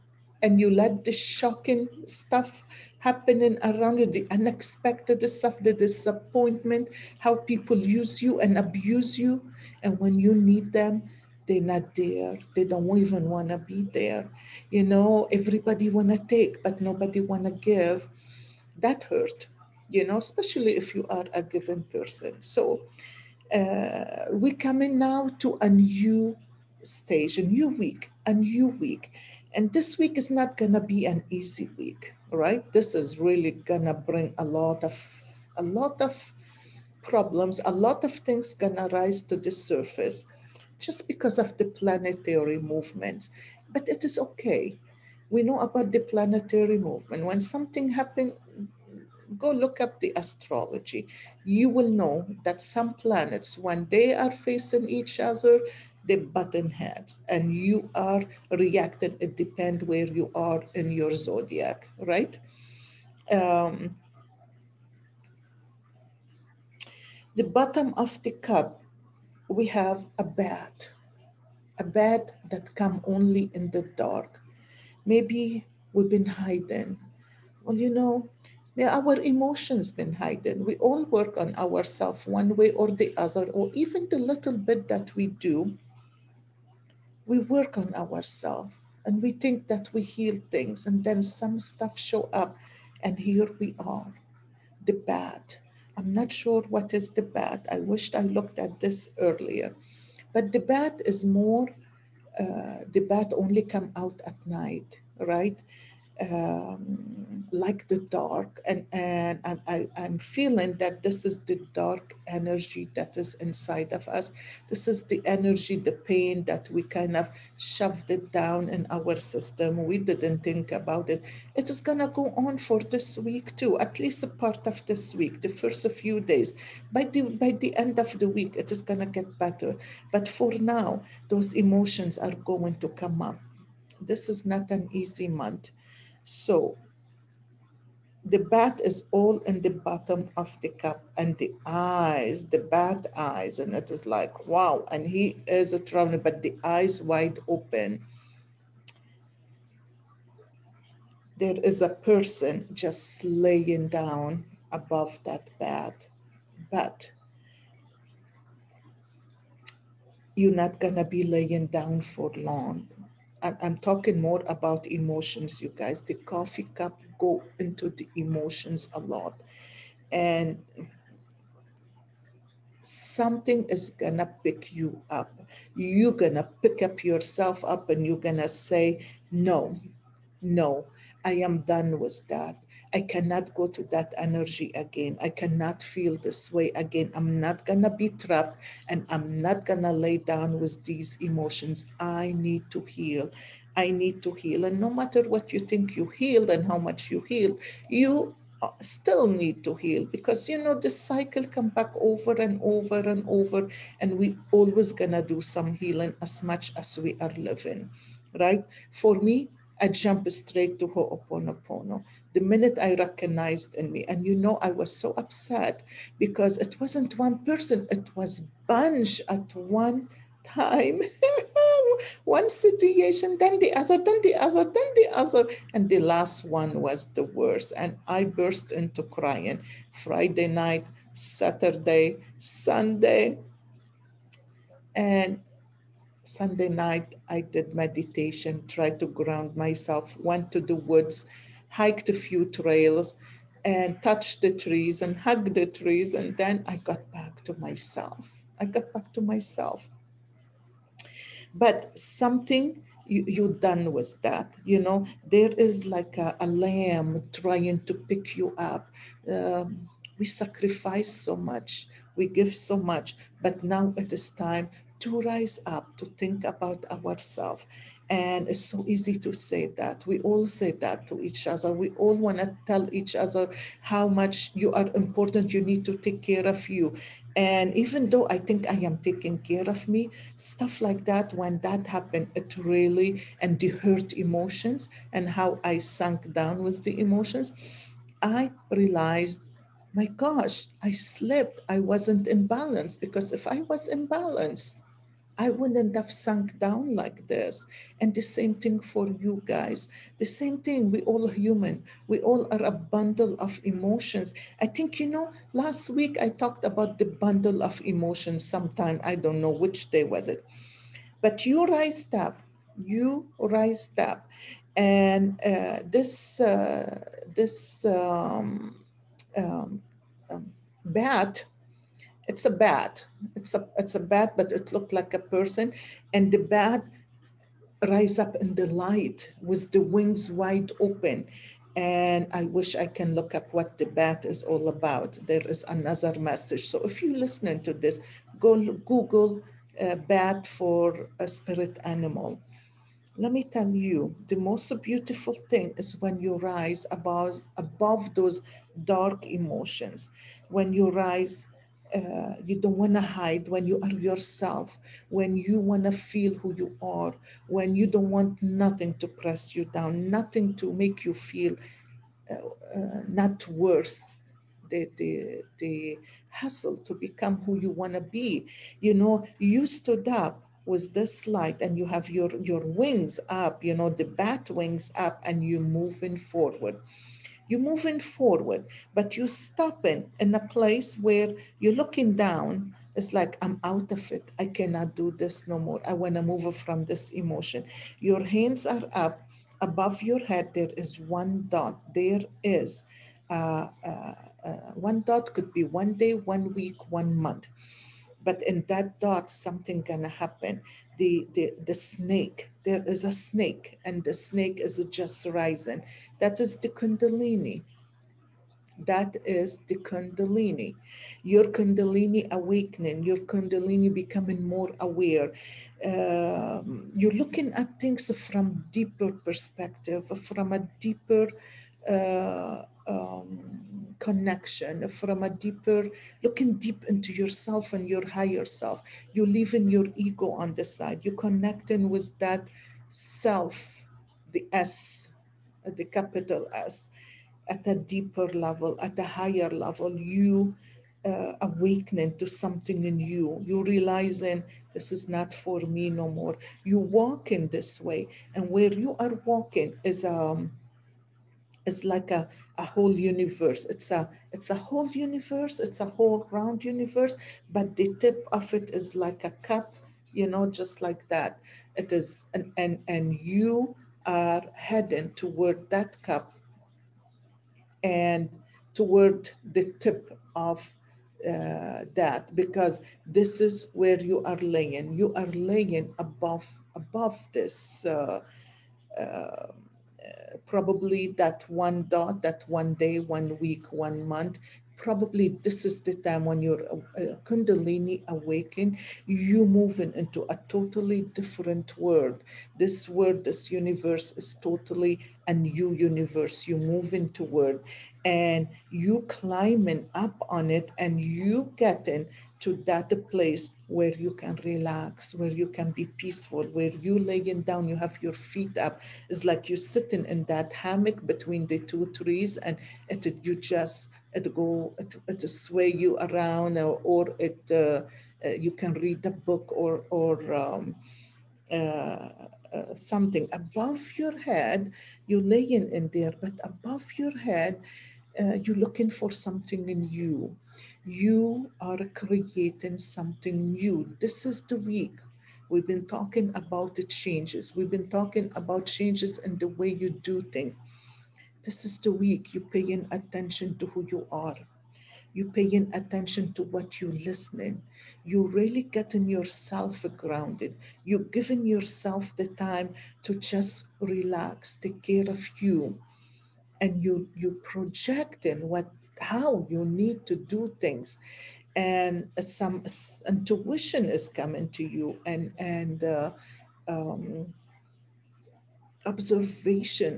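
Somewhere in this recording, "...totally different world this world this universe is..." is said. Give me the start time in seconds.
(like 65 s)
490 s.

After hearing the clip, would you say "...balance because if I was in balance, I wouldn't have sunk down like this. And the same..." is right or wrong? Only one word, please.
right.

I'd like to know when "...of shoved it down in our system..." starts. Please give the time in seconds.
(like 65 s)
117 s.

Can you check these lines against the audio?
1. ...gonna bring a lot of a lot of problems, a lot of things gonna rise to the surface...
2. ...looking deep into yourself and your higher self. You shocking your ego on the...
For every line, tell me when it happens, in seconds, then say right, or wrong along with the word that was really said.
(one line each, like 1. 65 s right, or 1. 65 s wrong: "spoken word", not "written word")
1. 33 s right
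2. 426 s wrong: "leaving", not "shocking".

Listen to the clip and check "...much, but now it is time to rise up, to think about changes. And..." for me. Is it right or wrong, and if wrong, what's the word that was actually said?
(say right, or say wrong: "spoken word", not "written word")
wrong: "ourselves", not "changes".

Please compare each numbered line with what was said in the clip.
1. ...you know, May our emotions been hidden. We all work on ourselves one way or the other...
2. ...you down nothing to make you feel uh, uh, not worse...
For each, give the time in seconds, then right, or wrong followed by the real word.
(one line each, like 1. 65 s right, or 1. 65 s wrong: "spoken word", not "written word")
1. 77 s right
2. 359 s right.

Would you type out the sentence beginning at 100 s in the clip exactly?
But the bad is more, uh, the bad only come out at night, right?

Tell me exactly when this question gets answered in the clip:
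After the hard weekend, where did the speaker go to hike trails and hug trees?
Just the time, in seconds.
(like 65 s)
240 s.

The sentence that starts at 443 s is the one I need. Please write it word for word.
You realizing this is not for me no more.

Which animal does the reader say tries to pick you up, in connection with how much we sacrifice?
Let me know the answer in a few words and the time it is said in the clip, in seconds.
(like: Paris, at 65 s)
Lamb, at 256 s.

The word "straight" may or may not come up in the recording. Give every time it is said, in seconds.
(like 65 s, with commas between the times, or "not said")
210 s.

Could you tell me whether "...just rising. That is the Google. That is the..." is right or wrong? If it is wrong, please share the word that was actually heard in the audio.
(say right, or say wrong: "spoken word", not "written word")
wrong: "Kundalini", not "Google".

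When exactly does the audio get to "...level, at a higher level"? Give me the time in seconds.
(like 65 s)
438 s.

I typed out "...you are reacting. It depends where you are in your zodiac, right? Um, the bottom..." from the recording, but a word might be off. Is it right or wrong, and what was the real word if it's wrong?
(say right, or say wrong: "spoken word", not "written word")
right.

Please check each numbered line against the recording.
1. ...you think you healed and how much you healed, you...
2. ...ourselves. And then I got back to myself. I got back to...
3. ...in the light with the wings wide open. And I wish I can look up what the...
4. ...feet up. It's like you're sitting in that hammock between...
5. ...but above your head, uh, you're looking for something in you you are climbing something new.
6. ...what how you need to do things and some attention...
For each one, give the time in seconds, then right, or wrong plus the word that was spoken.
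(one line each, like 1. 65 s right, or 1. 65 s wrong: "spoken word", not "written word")
1. 195 s right
2. 245 s wrong: "trees", not "ourselves"
3. 328 s right
4. 508 s right
5. 526 s wrong: "creating", not "climbing"
6. 558 s wrong: "intuition", not "attention".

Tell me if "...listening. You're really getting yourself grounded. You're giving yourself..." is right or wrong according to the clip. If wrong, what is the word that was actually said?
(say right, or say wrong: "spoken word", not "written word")
right.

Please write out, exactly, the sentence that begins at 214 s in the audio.
And you know, I was so upset because it wasn't one person, it was bunch at one time.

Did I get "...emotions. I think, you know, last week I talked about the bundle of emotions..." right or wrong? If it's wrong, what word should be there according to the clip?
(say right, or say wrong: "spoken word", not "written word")
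right.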